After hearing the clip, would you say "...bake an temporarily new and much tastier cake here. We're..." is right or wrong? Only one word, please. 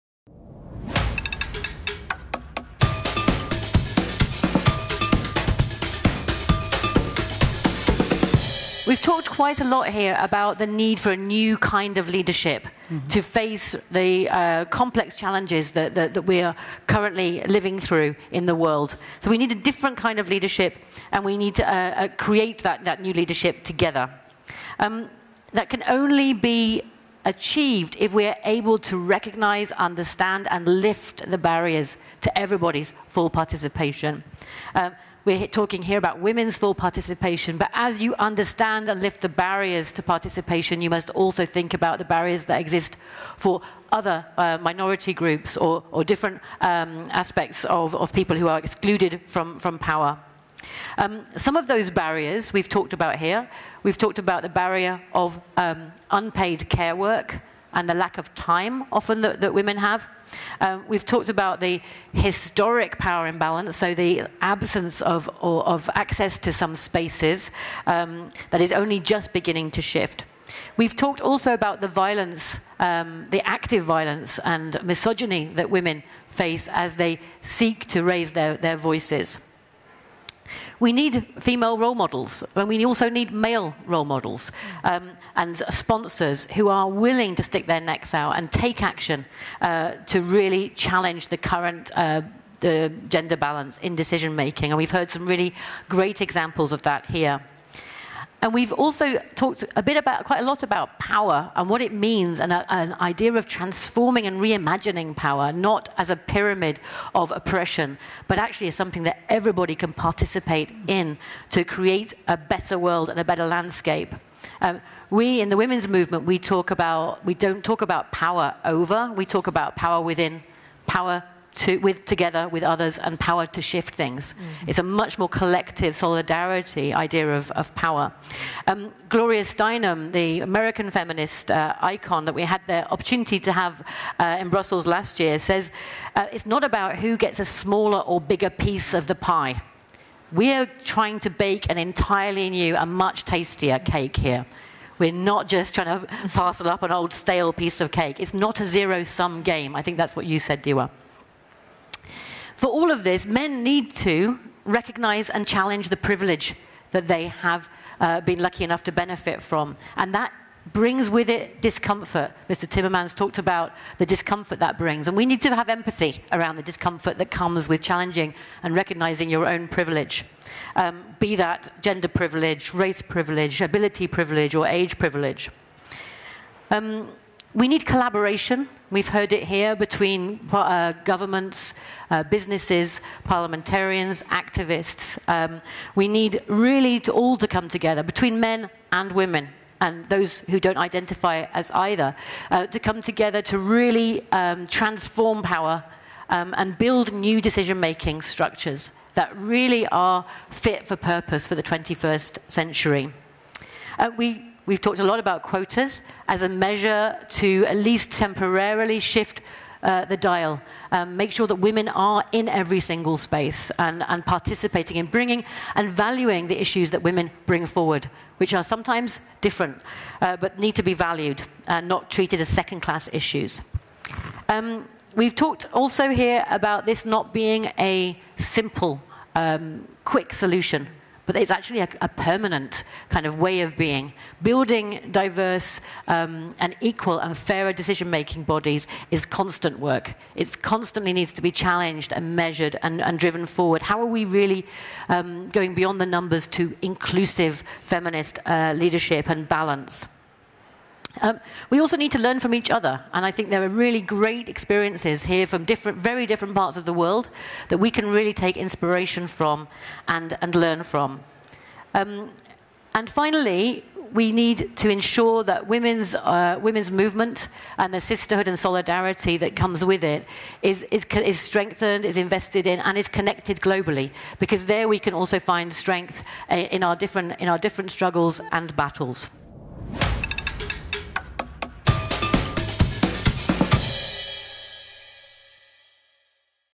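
wrong.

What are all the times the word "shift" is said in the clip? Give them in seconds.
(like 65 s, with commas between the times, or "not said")
69 s, 123 s, 208 s.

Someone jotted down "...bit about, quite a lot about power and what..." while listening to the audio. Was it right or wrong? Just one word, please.
right.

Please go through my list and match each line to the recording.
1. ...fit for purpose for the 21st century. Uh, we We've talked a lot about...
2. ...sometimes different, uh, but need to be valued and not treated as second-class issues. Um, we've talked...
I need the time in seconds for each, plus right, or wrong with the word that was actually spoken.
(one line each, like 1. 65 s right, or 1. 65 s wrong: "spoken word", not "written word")
1. 200 s right
2. 218 s right.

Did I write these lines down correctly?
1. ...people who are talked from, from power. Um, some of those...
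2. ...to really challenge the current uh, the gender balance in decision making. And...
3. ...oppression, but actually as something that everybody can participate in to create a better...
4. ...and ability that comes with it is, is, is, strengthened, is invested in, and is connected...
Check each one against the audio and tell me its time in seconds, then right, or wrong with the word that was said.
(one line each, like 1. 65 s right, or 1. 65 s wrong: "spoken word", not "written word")
1. 48 s wrong: "excluded", not "talked"
2. 90 s right
3. 107 s right
4. 268 s wrong: "solidarity", not "ability".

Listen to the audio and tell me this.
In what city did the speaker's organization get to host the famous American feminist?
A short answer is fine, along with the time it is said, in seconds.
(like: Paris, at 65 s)
Brussels, at 134 s.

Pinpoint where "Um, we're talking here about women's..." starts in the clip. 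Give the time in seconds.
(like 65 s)
34 s.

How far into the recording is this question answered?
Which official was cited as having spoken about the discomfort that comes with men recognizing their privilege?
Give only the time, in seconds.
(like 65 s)
162 s.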